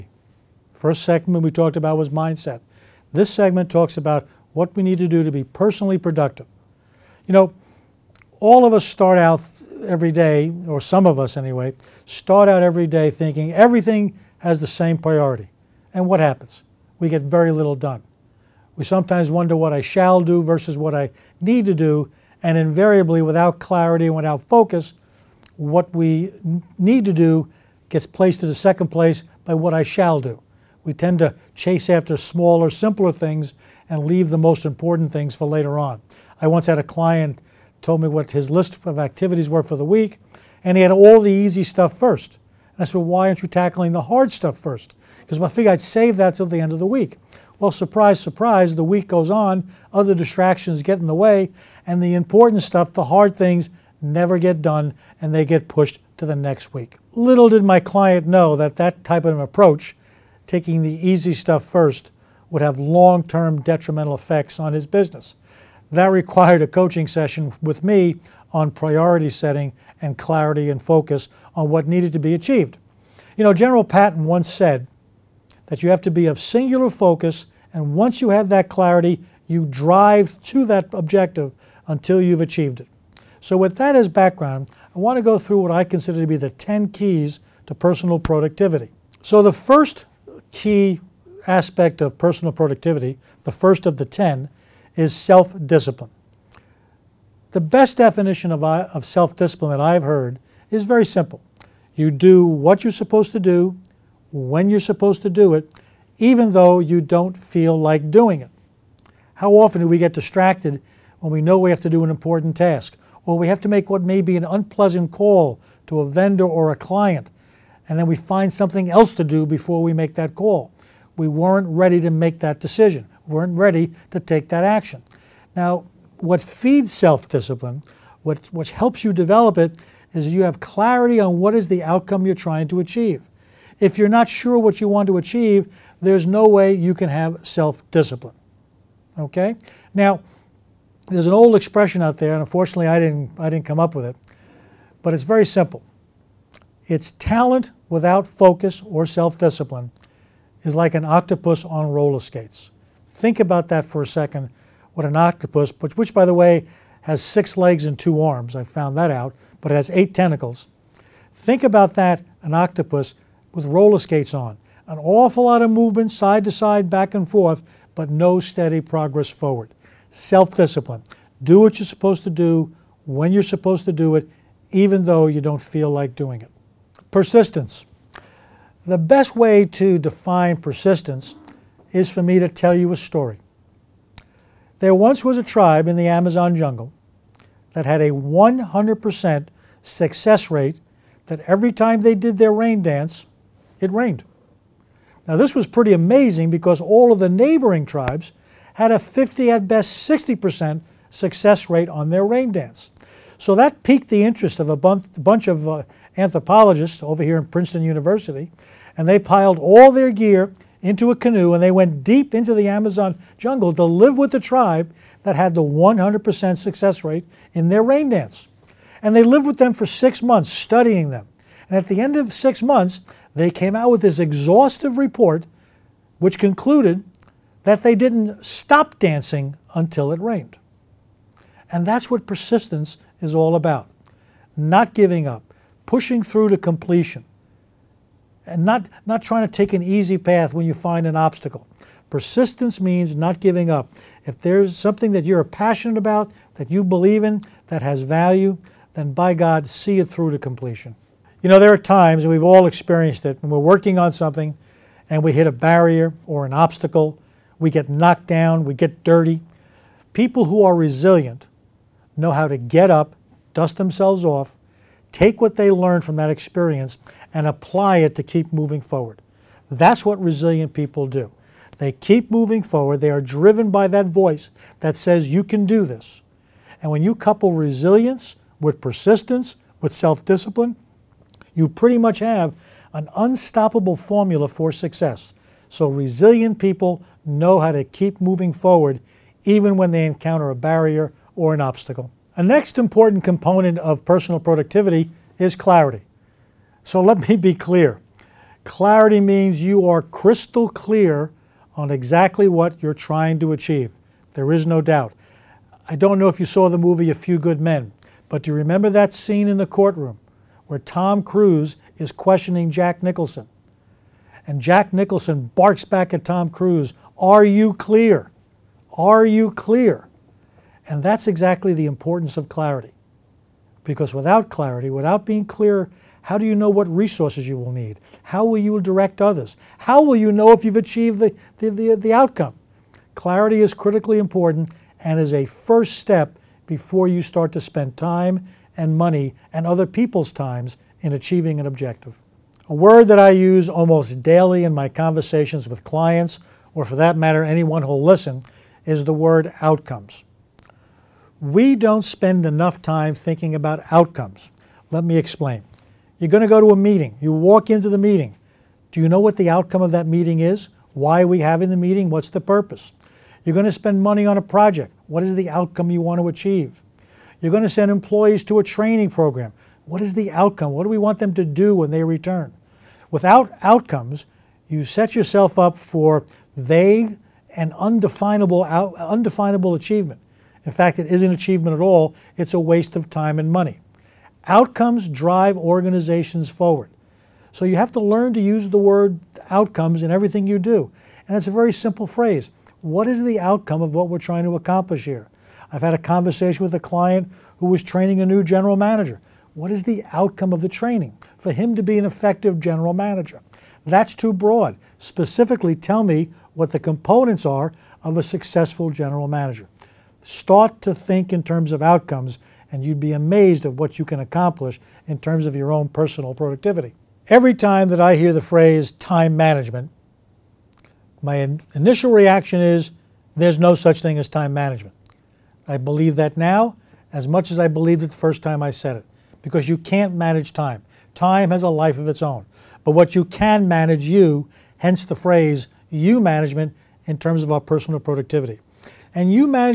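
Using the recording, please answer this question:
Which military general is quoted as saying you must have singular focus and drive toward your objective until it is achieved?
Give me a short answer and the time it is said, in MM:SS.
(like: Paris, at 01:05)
General Patton, at 01:13.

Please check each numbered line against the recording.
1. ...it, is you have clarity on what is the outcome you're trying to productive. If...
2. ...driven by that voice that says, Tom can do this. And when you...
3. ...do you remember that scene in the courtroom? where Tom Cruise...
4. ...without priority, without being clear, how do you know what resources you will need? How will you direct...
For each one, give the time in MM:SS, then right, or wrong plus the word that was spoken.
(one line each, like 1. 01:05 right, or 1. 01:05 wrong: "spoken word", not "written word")
1. 02:09 wrong: "achieve", not "productive"
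2. 04:33 wrong: "You", not "Tom"
3. 05:08 right
4. 05:24 wrong: "clarity", not "priority".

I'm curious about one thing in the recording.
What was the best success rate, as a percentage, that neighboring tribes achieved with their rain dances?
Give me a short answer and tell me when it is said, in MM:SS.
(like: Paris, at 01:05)
60%, at 03:20.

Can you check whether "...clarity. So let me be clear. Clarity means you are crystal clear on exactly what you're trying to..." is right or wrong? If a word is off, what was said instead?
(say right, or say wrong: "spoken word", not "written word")
right.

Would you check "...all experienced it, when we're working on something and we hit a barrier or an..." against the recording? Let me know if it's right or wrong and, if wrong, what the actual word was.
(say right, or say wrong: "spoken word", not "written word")
right.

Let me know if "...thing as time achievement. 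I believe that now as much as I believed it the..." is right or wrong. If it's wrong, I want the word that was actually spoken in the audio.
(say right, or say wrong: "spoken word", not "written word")
wrong: "management", not "achievement".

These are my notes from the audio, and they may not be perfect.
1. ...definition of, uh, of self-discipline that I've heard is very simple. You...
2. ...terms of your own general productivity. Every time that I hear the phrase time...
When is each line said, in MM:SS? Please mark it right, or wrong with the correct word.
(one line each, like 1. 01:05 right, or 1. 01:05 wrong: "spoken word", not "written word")
1. 01:37 right
2. 06:55 wrong: "personal", not "general".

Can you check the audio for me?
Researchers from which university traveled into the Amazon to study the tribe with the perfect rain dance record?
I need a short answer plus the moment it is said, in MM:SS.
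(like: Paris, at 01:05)
Princeton University, at 03:27.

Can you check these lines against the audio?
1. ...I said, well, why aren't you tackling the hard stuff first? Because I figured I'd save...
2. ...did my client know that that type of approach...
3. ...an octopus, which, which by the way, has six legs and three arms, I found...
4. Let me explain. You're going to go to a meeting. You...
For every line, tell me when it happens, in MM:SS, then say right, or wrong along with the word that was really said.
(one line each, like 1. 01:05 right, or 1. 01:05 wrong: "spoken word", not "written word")
1. 00:42 right
2. 00:57 right
3. 02:35 wrong: "two", not "three"
4. 05:54 right.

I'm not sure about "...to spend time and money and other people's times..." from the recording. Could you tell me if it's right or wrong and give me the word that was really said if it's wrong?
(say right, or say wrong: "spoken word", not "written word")
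right.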